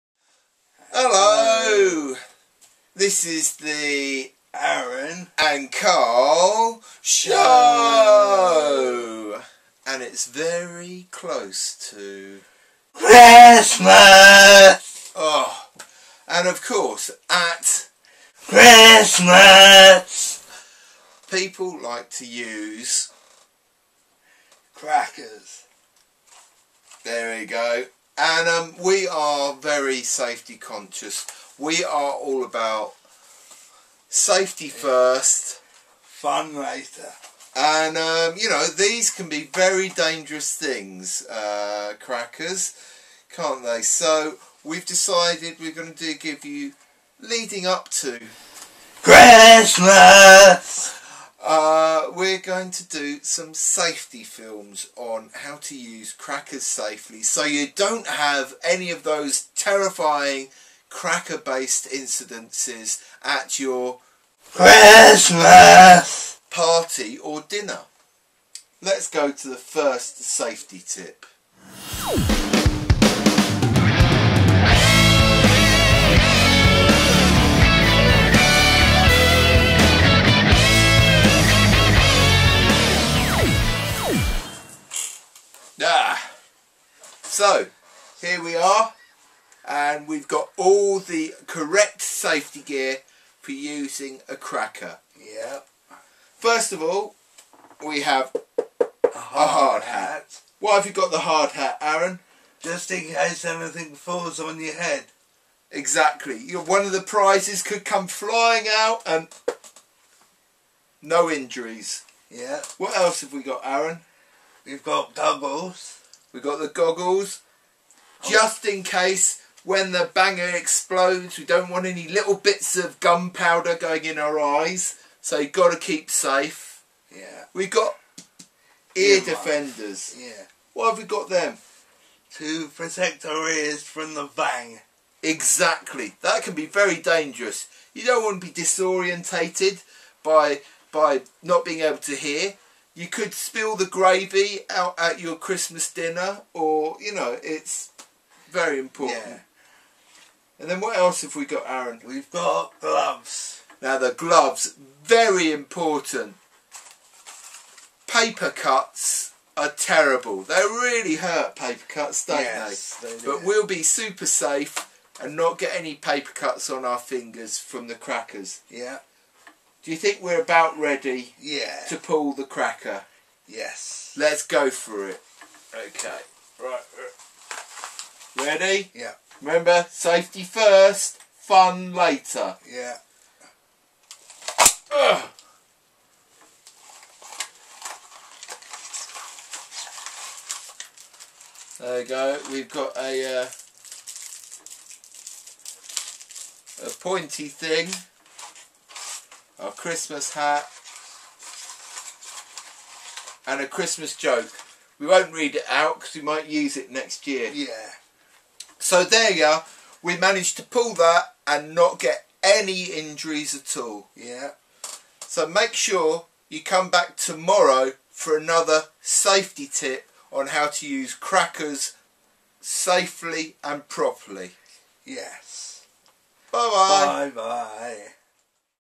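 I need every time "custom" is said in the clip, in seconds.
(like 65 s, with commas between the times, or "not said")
not said.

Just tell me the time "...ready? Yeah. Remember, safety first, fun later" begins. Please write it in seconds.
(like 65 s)
178 s.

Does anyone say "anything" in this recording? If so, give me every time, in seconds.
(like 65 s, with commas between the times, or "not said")
103 s.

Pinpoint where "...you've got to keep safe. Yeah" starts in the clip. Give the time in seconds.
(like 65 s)
125 s.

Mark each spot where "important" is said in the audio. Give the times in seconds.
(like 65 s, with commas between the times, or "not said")
148 s, 155 s.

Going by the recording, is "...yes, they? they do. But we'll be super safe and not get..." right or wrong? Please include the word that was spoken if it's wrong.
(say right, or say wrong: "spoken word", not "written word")
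right.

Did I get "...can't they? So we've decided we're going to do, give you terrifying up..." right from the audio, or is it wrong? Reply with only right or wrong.
wrong.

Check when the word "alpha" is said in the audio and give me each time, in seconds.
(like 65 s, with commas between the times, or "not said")
not said.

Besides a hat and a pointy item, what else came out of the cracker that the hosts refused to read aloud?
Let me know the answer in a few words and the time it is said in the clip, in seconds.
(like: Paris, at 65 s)
A Christmas joke, at 203 s.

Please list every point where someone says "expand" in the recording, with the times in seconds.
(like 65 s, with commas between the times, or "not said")
not said.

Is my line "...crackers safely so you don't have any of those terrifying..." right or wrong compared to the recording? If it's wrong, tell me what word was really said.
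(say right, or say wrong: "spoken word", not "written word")
right.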